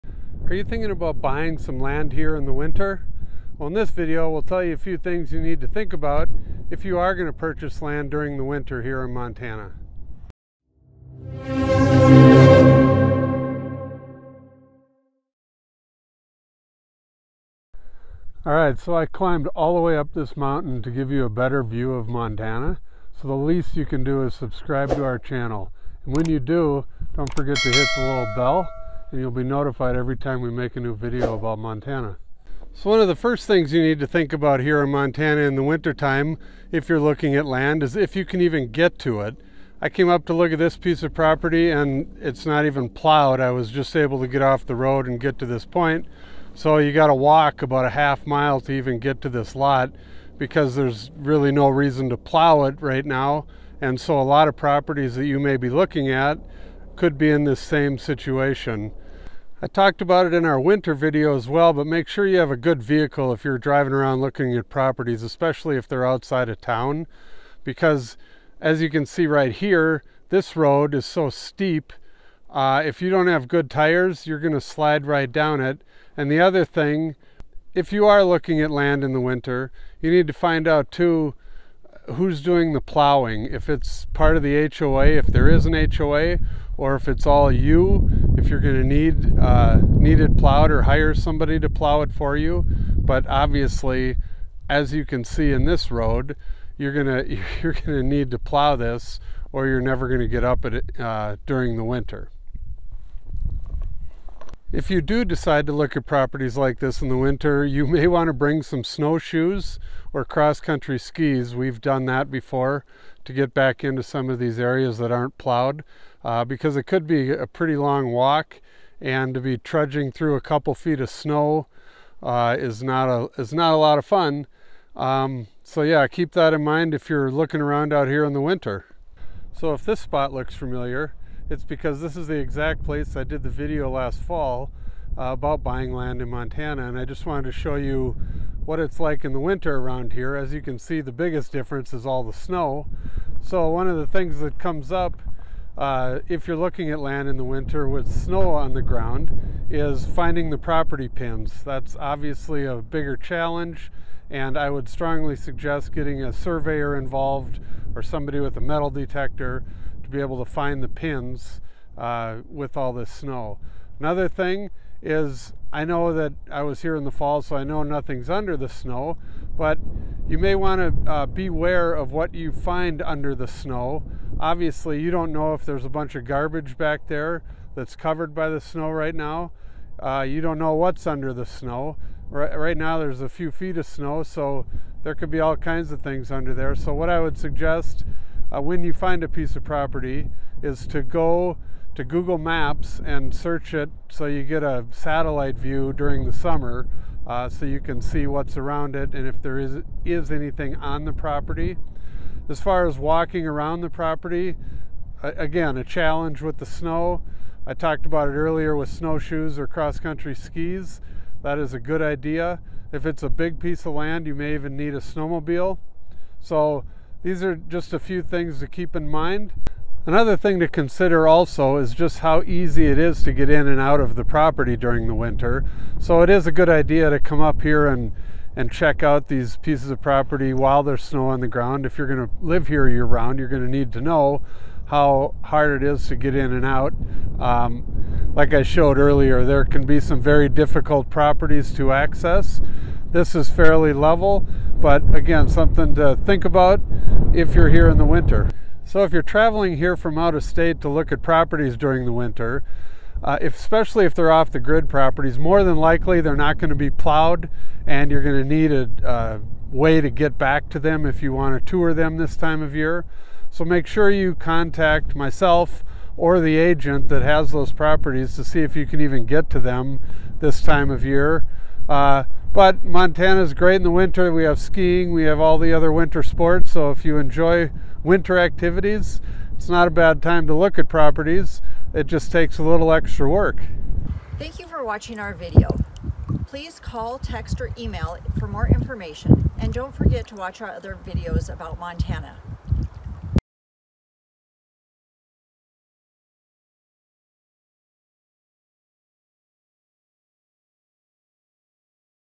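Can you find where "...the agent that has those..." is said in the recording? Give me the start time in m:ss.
4:26.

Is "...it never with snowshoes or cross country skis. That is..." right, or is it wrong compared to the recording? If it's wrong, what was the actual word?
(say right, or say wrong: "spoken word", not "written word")
wrong: "earlier", not "never".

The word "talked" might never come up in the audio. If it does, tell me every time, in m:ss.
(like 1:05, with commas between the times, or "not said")
0:59, 3:27.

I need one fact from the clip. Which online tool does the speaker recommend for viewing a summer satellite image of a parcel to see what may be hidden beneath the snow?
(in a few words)
Google Maps.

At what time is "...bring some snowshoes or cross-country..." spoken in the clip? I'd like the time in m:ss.
1:48.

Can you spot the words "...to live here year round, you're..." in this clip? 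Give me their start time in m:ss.
3:52.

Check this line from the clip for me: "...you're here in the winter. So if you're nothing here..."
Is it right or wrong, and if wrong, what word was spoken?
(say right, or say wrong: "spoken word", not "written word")
wrong: "traveling", not "nothing".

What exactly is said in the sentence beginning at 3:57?
Um, like I showed earlier, there can be some very difficult properties to access.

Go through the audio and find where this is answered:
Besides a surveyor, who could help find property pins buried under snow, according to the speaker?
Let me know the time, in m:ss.
2:38.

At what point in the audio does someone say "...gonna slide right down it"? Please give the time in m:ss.
1:14.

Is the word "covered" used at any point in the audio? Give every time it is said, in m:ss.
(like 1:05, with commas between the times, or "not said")
2:57.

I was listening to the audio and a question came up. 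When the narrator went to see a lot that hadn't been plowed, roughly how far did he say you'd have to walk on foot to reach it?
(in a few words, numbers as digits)
half mile.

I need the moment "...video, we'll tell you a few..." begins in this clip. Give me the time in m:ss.
0:03.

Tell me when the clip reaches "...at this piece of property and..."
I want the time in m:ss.
0:40.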